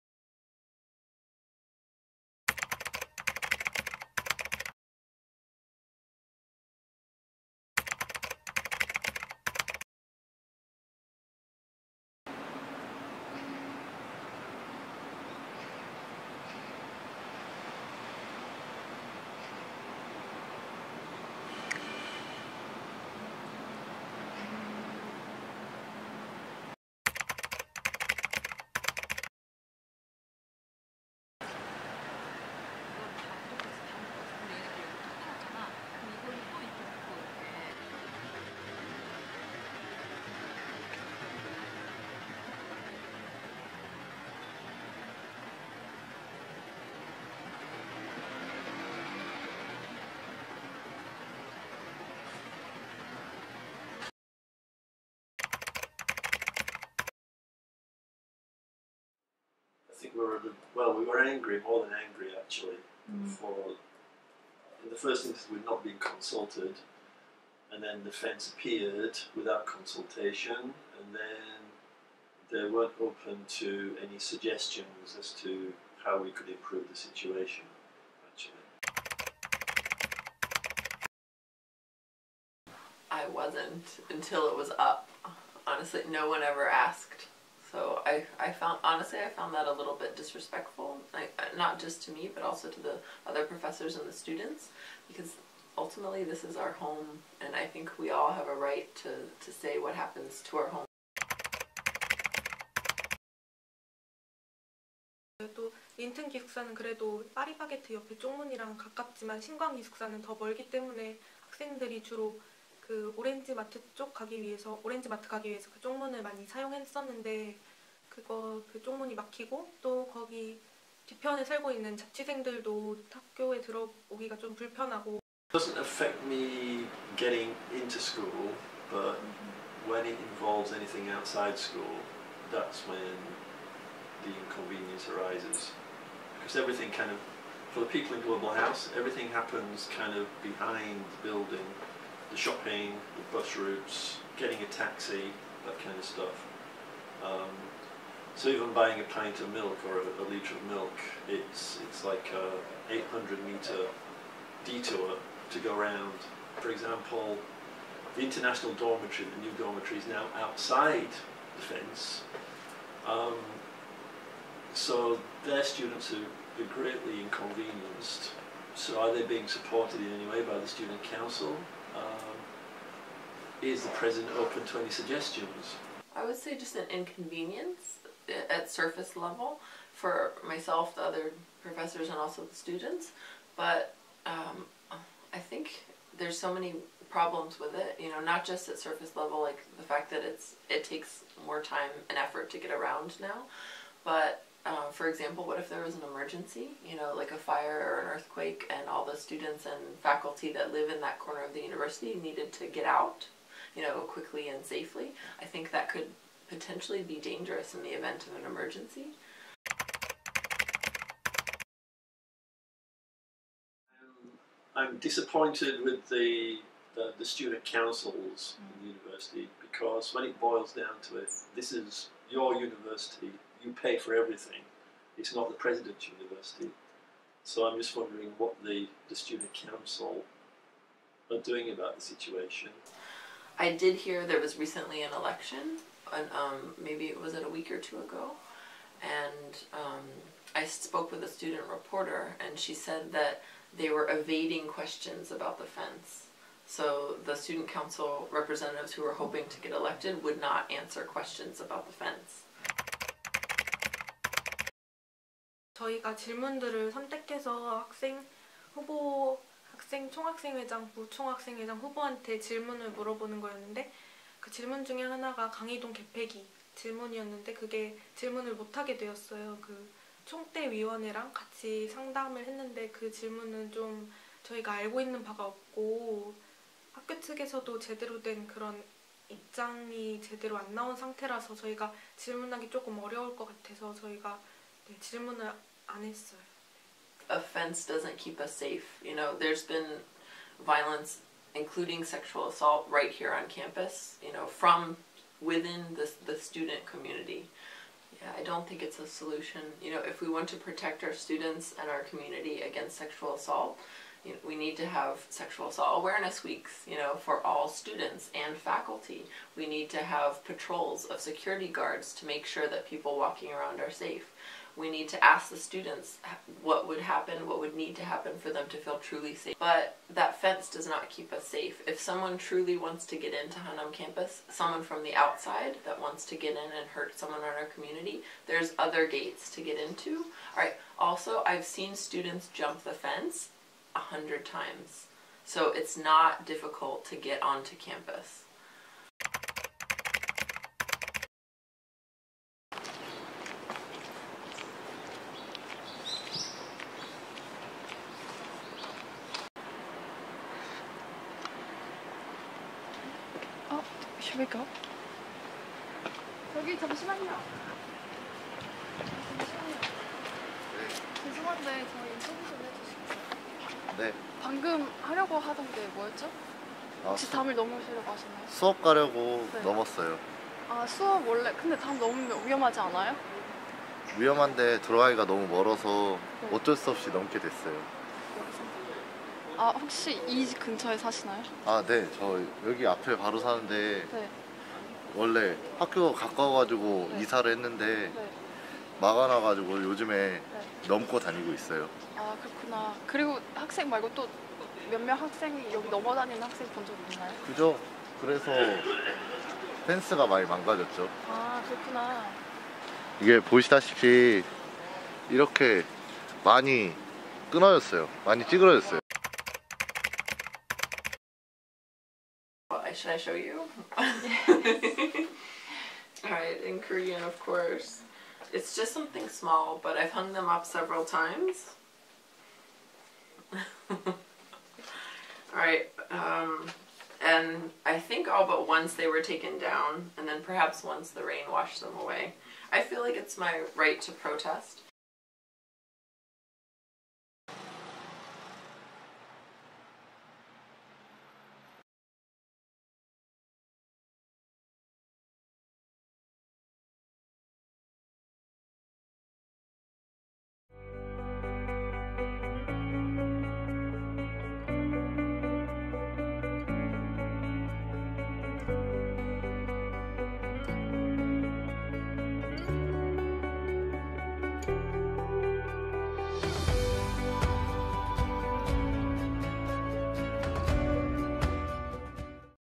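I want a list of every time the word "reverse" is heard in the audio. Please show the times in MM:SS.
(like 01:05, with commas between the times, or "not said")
not said.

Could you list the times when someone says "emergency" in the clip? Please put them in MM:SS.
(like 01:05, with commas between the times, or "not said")
03:16, 03:28.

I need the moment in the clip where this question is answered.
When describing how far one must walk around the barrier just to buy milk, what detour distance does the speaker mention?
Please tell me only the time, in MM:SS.
02:32.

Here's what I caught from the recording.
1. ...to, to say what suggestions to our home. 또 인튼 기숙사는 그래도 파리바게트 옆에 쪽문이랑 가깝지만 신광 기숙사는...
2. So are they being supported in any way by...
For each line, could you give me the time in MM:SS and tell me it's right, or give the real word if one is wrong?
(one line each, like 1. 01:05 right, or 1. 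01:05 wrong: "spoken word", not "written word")
1. 01:39 wrong: "happens", not "suggestions"
2. 02:48 right.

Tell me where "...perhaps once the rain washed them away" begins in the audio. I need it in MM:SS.
07:10.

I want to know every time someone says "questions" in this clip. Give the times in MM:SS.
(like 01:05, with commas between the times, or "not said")
04:04, 04:11.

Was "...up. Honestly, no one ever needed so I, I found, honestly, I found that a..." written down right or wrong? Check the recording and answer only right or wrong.
wrong.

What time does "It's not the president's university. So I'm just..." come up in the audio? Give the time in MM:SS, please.
03:45.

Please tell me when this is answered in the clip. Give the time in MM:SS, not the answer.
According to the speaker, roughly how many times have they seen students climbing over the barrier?
05:33.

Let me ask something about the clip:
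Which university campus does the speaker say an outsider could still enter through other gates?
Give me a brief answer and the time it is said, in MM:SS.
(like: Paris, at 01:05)
Hannam, at 05:23.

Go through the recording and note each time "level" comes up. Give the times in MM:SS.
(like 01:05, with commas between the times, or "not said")
02:59, 03:09.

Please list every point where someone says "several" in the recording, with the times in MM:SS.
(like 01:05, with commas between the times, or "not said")
07:00.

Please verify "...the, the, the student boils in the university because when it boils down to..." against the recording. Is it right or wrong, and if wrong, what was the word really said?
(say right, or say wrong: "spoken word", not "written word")
wrong: "councils", not "boils".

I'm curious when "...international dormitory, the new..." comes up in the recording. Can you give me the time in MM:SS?
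02:38.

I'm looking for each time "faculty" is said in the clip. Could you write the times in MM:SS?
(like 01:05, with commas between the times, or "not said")
03:20, 05:08.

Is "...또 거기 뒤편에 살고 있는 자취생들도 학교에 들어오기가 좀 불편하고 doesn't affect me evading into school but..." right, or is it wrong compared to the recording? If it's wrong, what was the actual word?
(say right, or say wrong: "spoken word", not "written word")
wrong: "getting", not "evading".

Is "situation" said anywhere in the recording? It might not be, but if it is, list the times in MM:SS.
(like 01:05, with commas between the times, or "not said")
01:16, 03:52.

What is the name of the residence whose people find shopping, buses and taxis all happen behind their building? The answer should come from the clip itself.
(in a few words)
Global House.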